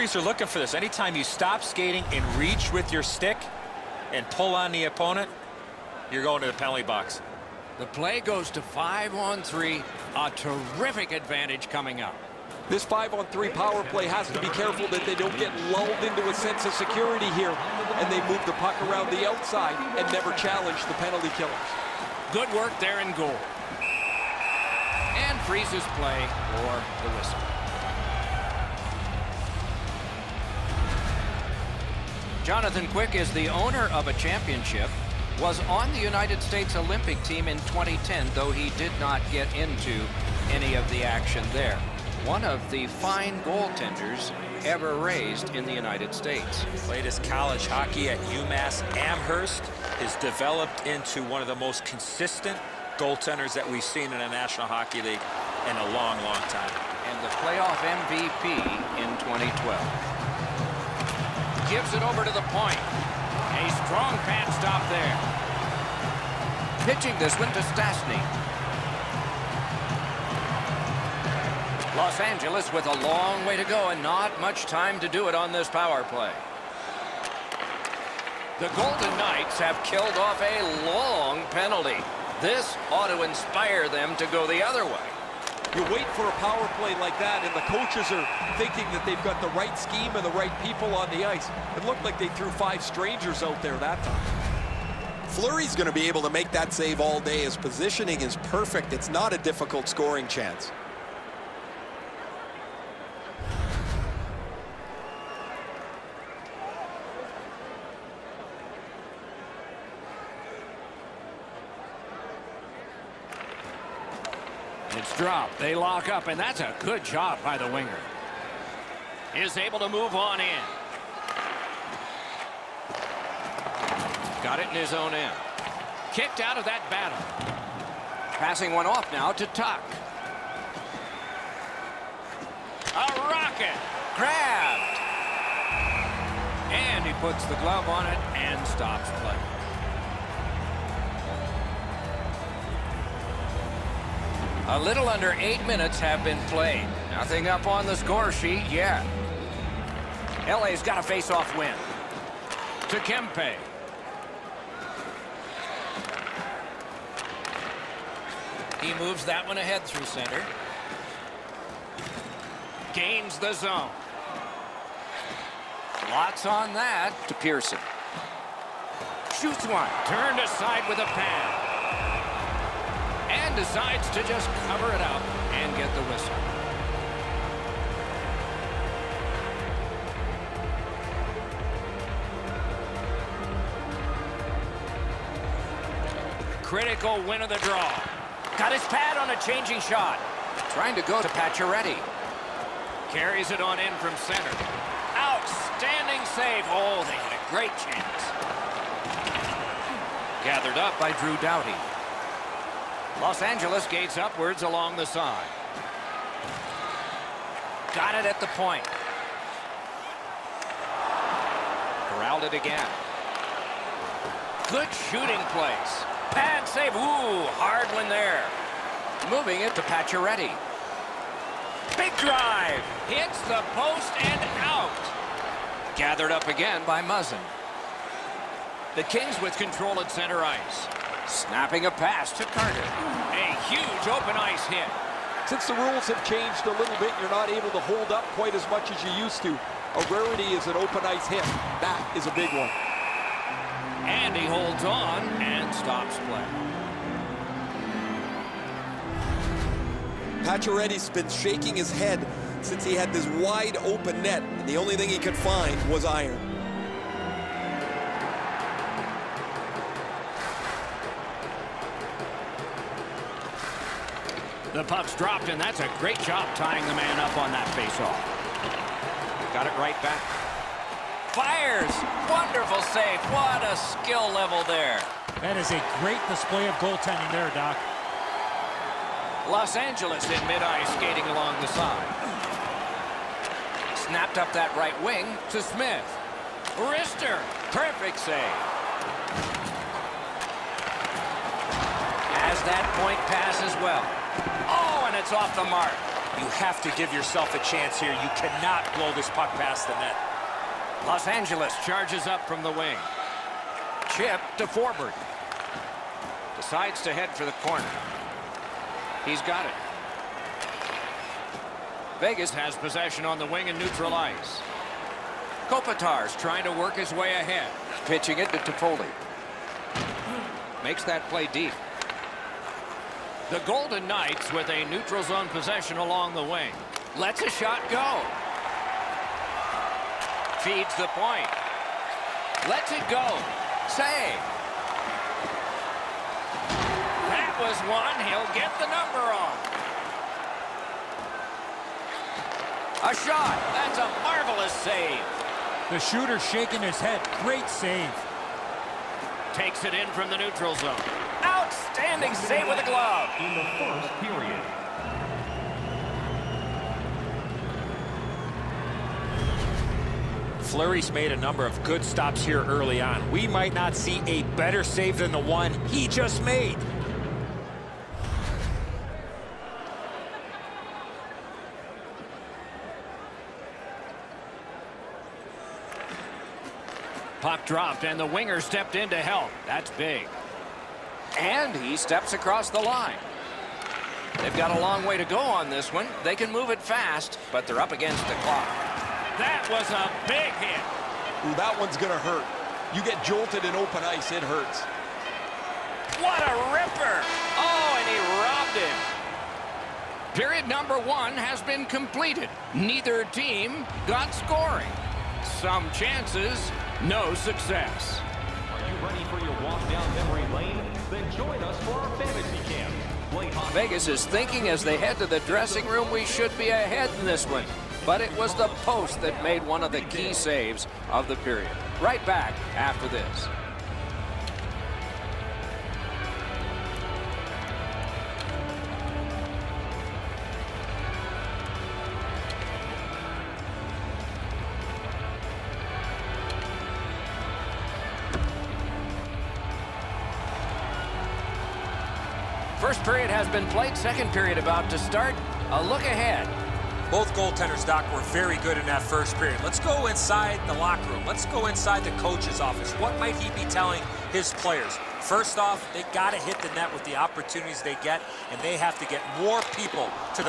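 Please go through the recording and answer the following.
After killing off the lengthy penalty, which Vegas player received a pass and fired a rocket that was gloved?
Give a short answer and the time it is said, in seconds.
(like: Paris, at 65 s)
Tuch, at 129 s.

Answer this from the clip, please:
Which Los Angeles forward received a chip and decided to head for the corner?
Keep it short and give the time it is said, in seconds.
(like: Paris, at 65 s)
Forbort, at 304 s.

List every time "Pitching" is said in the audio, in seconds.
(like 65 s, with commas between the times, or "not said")
66 s, 318 s.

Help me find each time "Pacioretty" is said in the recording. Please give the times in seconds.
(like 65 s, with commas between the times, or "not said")
191 s, 219 s, 250 s.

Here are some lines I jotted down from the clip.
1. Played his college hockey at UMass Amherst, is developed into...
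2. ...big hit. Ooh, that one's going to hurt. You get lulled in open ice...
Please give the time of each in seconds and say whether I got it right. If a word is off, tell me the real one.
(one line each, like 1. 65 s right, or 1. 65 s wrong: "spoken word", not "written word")
1. 46 s right
2. 390 s wrong: "jolted", not "lulled".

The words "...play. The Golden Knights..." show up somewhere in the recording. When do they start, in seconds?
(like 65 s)
76 s.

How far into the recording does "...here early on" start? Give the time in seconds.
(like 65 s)
362 s.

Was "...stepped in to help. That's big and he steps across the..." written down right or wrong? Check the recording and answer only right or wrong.
right.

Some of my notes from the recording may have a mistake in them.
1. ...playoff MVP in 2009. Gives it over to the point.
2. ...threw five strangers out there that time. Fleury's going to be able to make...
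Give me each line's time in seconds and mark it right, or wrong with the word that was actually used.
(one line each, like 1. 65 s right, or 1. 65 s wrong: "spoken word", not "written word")
1. 57 s wrong: "2012", not "2009"
2. 92 s right.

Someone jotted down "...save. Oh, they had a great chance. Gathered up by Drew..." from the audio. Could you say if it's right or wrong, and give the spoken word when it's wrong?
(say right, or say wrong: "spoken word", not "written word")
right.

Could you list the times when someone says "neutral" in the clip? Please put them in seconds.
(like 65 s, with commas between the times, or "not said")
313 s, 324 s, 350 s.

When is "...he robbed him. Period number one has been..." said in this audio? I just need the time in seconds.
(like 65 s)
398 s.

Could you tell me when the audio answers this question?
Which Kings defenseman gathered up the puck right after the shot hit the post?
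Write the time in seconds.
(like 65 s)
227 s.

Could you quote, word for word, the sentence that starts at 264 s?
The puck's dropped, and that's a great job tying the man up on that faceoff.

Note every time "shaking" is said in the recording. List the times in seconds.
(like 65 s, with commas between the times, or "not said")
251 s, 346 s.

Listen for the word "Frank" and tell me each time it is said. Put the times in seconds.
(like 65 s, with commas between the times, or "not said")
not said.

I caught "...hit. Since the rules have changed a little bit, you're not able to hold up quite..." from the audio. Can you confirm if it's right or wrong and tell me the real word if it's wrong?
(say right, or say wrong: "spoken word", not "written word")
right.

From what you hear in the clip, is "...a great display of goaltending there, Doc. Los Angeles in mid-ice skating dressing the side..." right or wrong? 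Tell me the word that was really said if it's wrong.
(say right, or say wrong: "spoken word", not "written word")
wrong: "along", not "dressing".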